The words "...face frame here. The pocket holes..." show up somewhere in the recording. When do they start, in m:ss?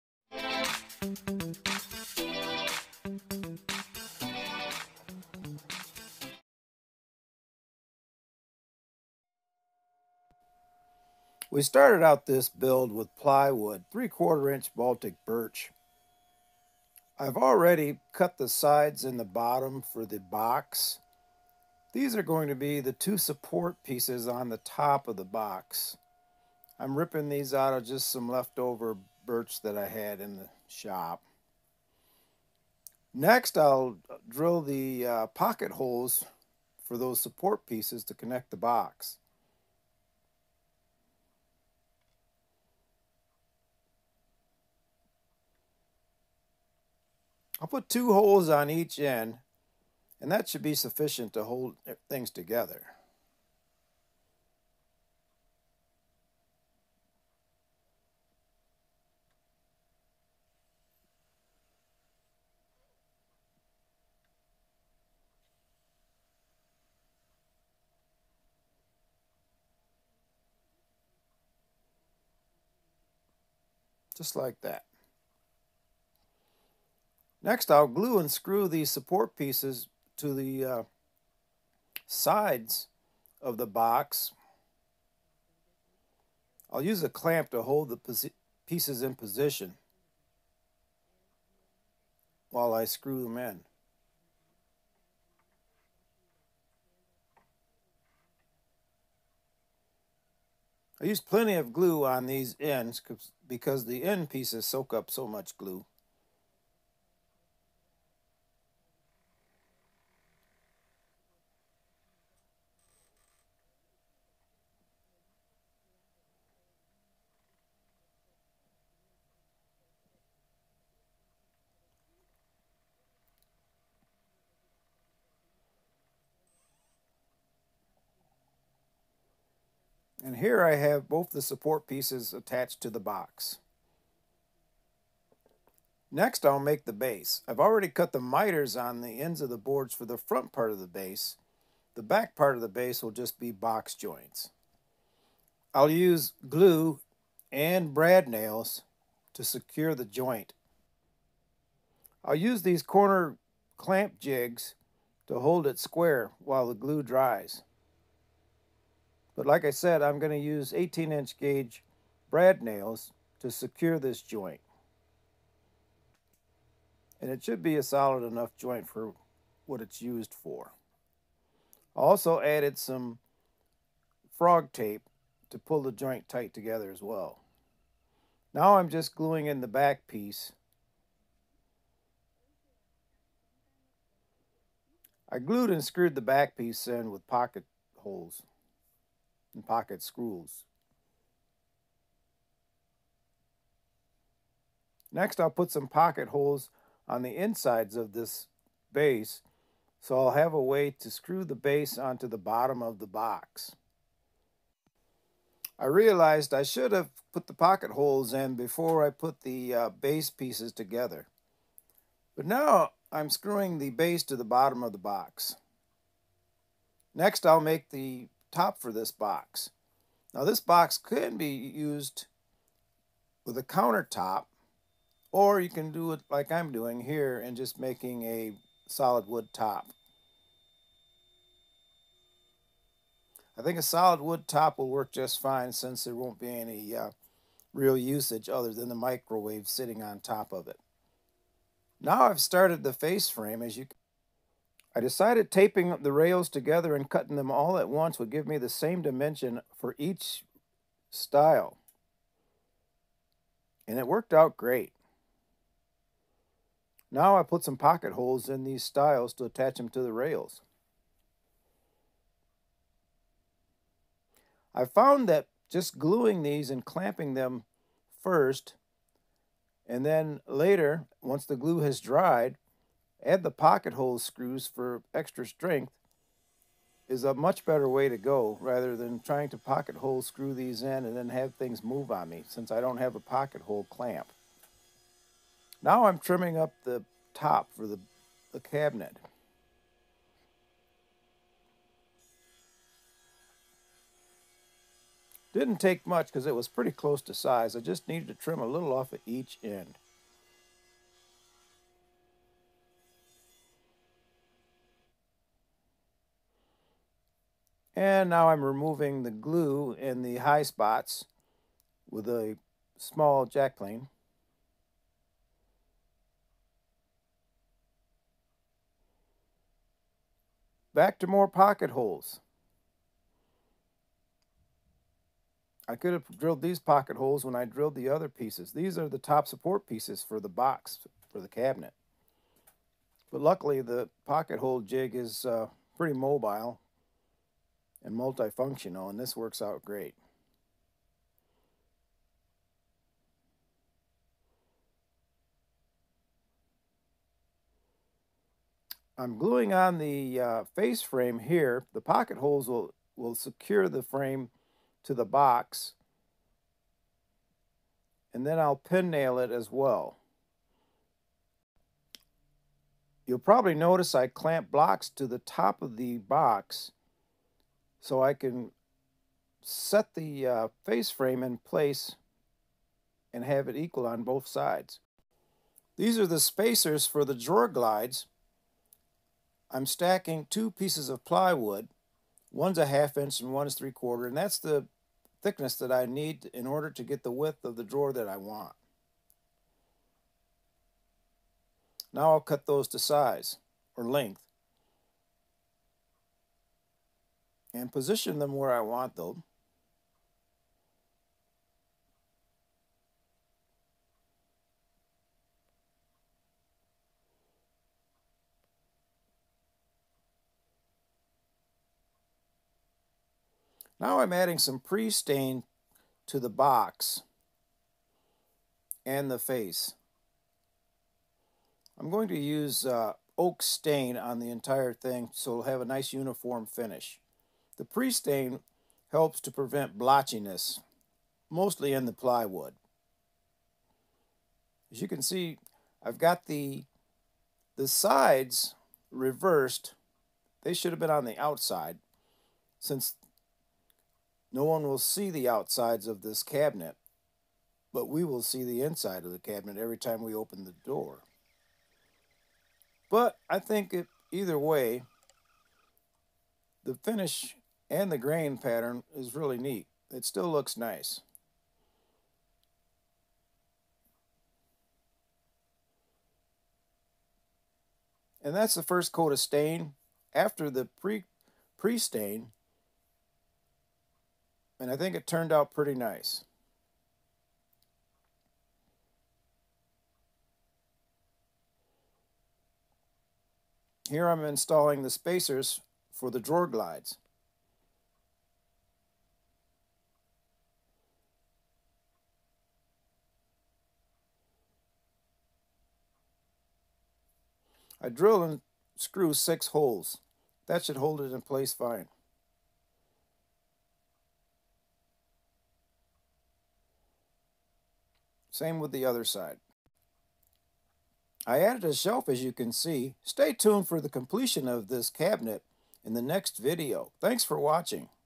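5:50.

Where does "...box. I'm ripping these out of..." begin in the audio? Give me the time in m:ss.
0:25.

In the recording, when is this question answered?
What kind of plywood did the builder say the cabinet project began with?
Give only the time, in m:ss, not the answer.
0:14.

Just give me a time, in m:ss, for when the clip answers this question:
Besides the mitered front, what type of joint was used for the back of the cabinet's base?
2:23.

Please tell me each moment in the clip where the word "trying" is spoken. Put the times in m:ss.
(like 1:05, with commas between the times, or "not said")
4:39.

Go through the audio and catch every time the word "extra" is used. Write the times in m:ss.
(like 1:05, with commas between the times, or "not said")
4:35.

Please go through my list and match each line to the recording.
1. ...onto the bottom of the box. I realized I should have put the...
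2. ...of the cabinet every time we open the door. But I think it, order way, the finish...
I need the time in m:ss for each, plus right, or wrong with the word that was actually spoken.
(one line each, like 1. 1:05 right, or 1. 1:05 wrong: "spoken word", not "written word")
1. 3:21 right
2. 7:29 wrong: "either", not "order".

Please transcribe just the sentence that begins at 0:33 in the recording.
Next, I'll drill the uh, pocket holes for those support pieces to connect the box.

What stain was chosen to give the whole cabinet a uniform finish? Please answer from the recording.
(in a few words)
oak.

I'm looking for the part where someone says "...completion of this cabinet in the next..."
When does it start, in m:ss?
8:34.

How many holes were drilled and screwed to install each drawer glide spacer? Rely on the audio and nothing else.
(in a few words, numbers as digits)
6.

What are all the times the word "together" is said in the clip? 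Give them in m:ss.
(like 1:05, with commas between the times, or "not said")
0:52, 2:56, 3:30, 4:06.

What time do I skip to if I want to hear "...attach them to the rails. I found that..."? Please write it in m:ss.
4:19.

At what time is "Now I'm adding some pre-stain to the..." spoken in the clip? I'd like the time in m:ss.
6:53.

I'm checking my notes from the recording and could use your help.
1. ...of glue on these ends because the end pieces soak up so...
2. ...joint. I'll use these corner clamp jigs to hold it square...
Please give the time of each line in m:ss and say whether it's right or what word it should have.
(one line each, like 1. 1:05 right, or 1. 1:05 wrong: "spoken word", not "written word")
1. 1:41 right
2. 2:30 right.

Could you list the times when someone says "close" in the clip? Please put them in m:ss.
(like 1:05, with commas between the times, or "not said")
4:56.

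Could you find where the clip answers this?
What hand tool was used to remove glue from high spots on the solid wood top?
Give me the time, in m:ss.
5:12.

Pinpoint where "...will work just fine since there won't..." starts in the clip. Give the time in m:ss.
3:54.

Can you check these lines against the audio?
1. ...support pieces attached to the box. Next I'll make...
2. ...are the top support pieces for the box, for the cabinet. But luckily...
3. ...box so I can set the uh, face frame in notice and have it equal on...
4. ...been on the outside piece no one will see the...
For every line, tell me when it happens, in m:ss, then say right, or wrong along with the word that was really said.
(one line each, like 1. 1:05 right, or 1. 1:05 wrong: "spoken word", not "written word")
1. 2:11 right
2. 5:28 right
3. 6:06 wrong: "place", not "notice"
4. 7:20 wrong: "since", not "piece".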